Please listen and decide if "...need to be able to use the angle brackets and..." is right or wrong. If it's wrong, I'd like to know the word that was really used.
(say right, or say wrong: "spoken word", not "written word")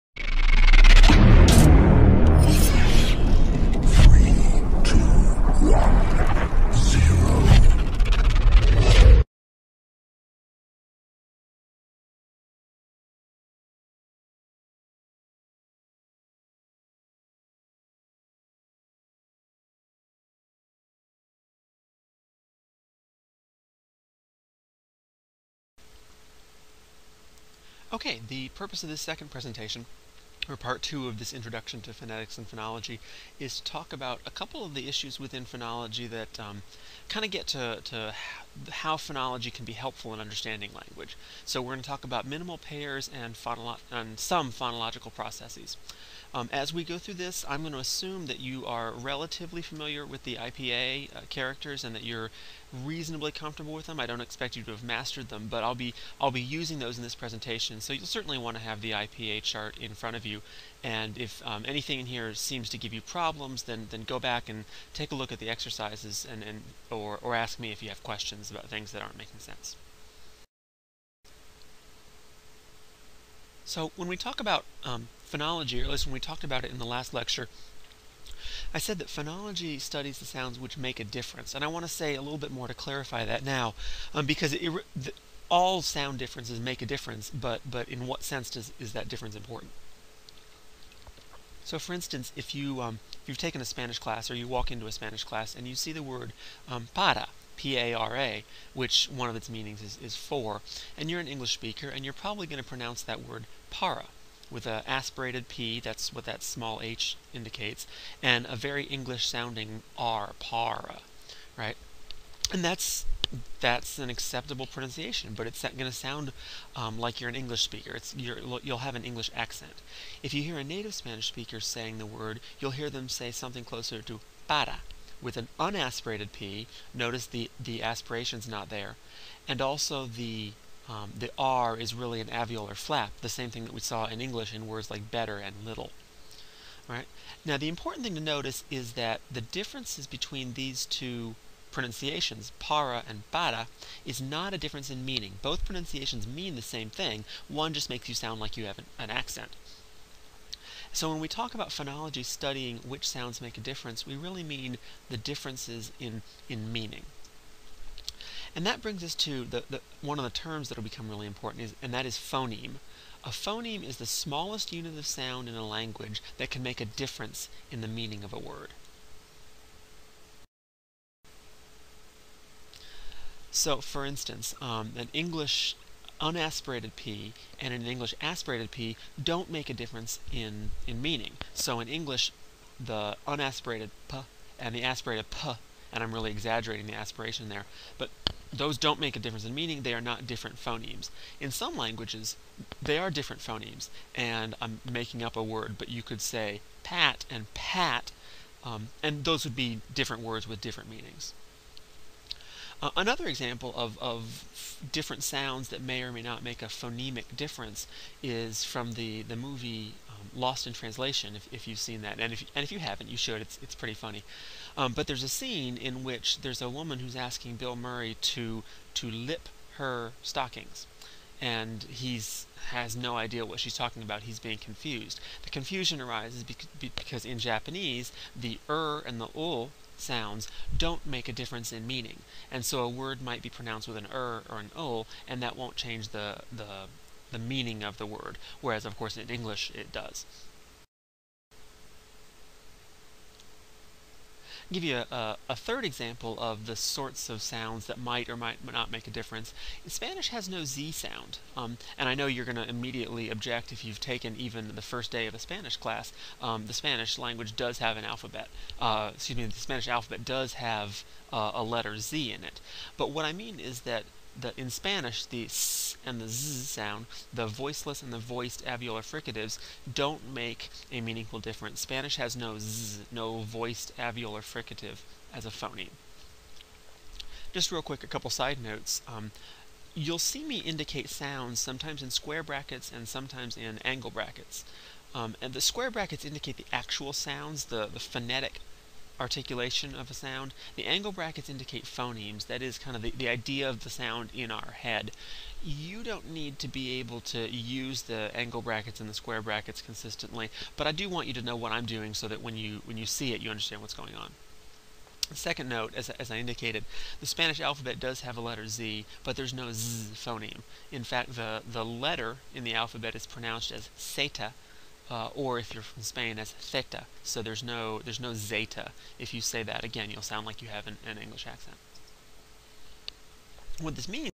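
right.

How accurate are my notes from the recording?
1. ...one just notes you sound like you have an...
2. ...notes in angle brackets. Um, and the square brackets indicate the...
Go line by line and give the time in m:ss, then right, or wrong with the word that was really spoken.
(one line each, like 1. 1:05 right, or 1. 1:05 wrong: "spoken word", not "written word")
1. 2:27 wrong: "makes", not "notes"
2. 4:43 wrong: "sometimes", not "notes".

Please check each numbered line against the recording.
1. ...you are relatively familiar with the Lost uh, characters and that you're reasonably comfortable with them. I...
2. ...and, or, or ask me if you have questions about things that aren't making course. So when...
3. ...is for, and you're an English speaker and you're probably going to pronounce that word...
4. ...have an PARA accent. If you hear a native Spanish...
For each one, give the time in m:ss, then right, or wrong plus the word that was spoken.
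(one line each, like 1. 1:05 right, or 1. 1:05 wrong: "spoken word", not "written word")
1. 0:48 wrong: "IPA", not "Lost"
2. 1:06 wrong: "sense", not "course"
3. 1:40 right
4. 1:58 wrong: "English", not "PARA".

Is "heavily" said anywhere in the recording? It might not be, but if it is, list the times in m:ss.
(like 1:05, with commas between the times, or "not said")
not said.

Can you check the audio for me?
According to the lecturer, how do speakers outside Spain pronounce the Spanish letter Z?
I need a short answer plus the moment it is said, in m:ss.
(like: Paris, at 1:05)
seta, at 5:13.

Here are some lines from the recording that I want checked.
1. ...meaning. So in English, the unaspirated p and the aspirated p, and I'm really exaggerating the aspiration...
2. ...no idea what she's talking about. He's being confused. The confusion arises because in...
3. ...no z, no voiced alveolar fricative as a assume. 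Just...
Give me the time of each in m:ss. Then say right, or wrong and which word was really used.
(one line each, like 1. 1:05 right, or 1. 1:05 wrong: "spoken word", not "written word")
1. 3:01 right
2. 3:42 right
3. 4:32 wrong: "phoneme", not "assume".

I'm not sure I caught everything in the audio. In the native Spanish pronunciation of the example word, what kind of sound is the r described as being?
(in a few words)
an alveolar flap.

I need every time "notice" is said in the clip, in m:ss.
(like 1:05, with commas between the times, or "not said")
2:06, 2:18.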